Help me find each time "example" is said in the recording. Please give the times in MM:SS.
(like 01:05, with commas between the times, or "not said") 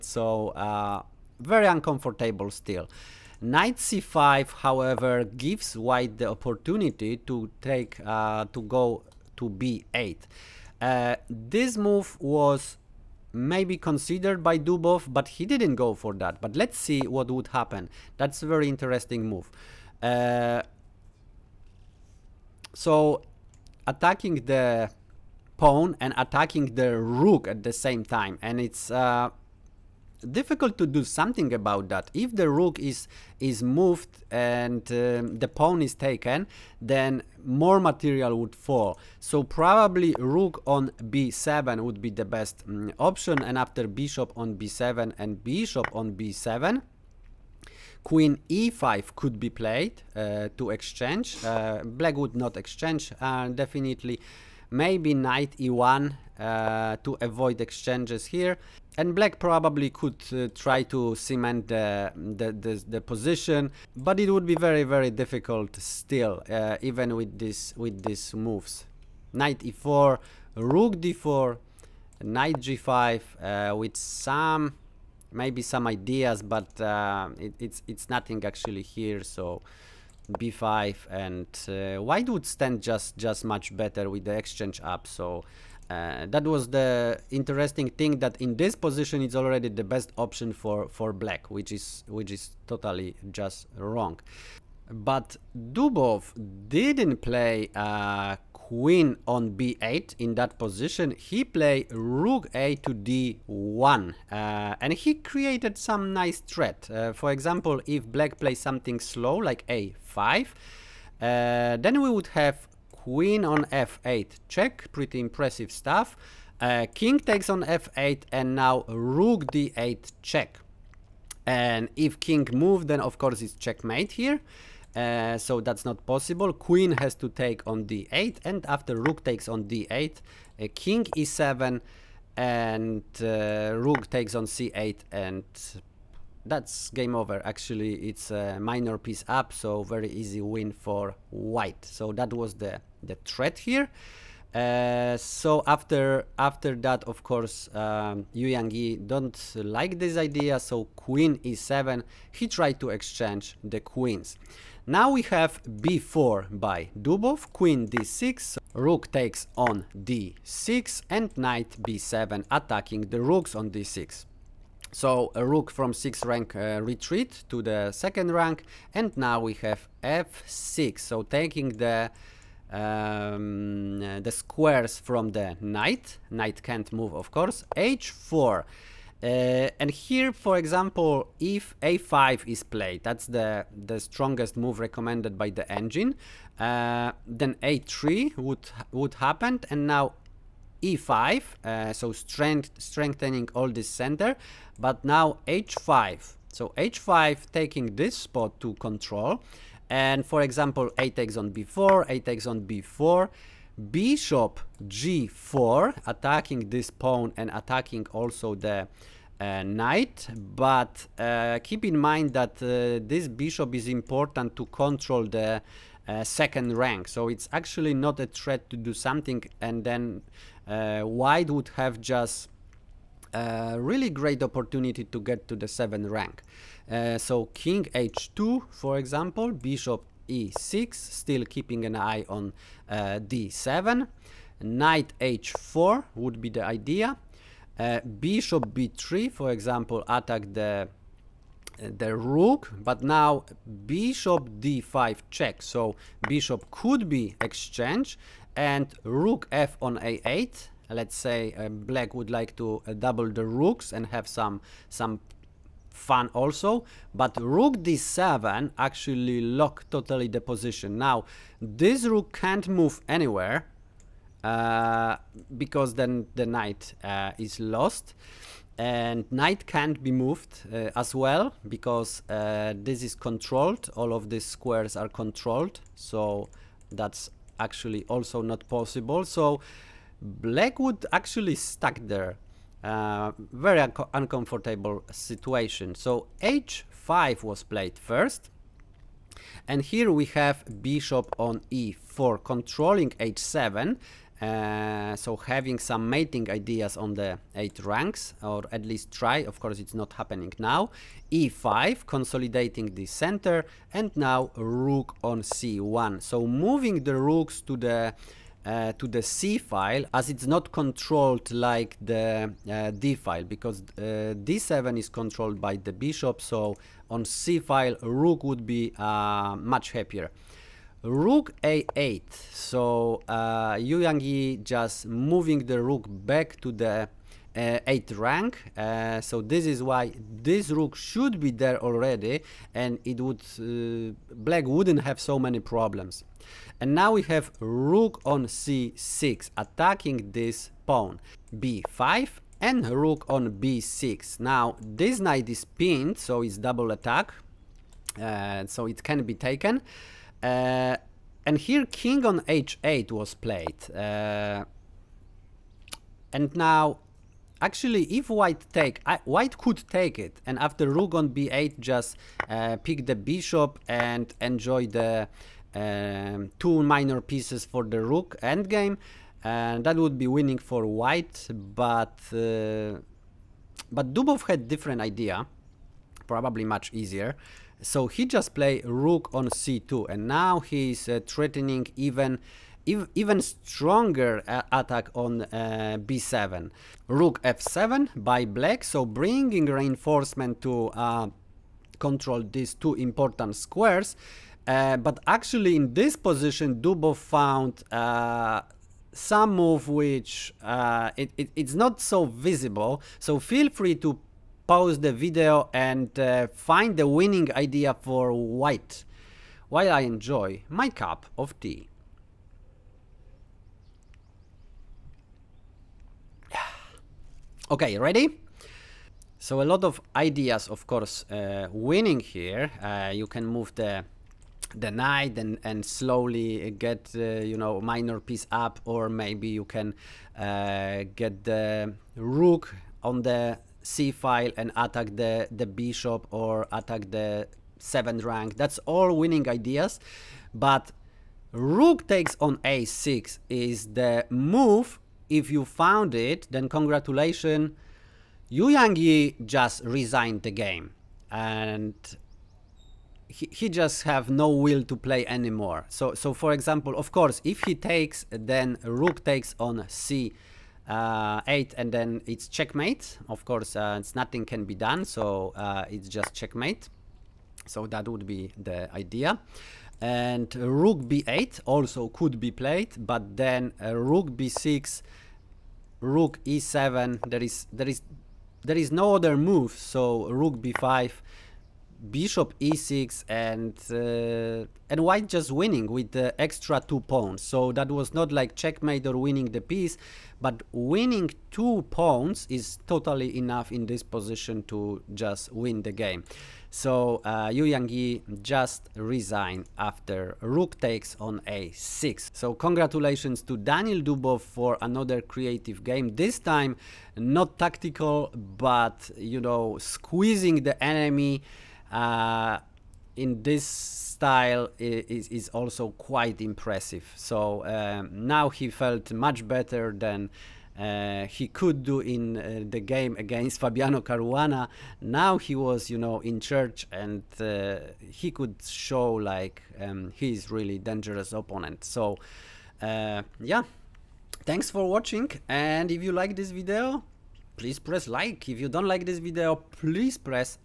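01:47, 03:00, 03:20, 03:48, 03:59, 07:36.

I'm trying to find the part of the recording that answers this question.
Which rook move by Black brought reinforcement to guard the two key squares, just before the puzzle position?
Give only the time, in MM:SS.
06:27.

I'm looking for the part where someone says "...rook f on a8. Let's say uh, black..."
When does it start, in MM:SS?
04:09.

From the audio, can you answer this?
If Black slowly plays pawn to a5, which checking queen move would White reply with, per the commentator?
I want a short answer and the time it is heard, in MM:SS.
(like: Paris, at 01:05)
Queen f8 check, at 01:53.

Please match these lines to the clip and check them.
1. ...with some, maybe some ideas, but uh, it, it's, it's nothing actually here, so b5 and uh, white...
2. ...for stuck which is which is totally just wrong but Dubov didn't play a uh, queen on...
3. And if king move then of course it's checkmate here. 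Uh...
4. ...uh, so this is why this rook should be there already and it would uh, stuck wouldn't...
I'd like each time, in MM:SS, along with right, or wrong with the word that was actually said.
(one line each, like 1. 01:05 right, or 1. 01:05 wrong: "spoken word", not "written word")
1. 01:13 right
2. 01:30 wrong: "black", not "stuck"
3. 02:01 right
4. 05:28 wrong: "black", not "stuck".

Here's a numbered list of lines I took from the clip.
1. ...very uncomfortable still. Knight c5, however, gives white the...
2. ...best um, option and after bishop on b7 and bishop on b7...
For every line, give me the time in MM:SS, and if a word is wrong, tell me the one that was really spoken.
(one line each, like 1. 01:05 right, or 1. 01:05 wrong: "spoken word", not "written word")
1. 00:01 right
2. 00:42 right.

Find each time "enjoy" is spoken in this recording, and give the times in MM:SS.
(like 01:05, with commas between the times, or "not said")
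06:04, 06:50.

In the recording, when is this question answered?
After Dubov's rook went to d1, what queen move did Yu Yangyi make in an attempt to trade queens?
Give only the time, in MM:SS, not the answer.
02:30.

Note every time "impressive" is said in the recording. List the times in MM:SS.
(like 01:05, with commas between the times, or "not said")
01:55, 08:36.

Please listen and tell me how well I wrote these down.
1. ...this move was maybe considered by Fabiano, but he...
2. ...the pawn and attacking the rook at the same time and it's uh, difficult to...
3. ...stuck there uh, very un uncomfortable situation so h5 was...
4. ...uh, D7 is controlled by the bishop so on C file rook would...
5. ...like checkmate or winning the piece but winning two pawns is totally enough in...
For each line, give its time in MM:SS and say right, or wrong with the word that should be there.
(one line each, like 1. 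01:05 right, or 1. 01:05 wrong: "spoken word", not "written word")
1. 00:11 wrong: "Dubov", not "Fabiano"
2. 00:24 right
3. 04:41 right
4. 05:13 right
5. 08:08 right.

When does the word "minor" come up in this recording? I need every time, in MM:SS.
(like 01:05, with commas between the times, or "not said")
02:18, 06:06, 07:07.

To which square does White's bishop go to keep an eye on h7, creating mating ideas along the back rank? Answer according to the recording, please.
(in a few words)
e4.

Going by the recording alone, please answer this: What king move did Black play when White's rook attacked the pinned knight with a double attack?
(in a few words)
King h8.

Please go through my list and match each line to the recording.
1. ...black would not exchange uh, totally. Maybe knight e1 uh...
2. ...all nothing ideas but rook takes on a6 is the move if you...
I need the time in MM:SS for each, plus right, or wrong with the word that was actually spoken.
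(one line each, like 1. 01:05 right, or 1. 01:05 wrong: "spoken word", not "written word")
1. 00:51 wrong: "definitely", not "totally"
2. 07:18 wrong: "winning", not "nothing".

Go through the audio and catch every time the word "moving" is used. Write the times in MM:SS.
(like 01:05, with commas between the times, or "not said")
05:06, 05:25.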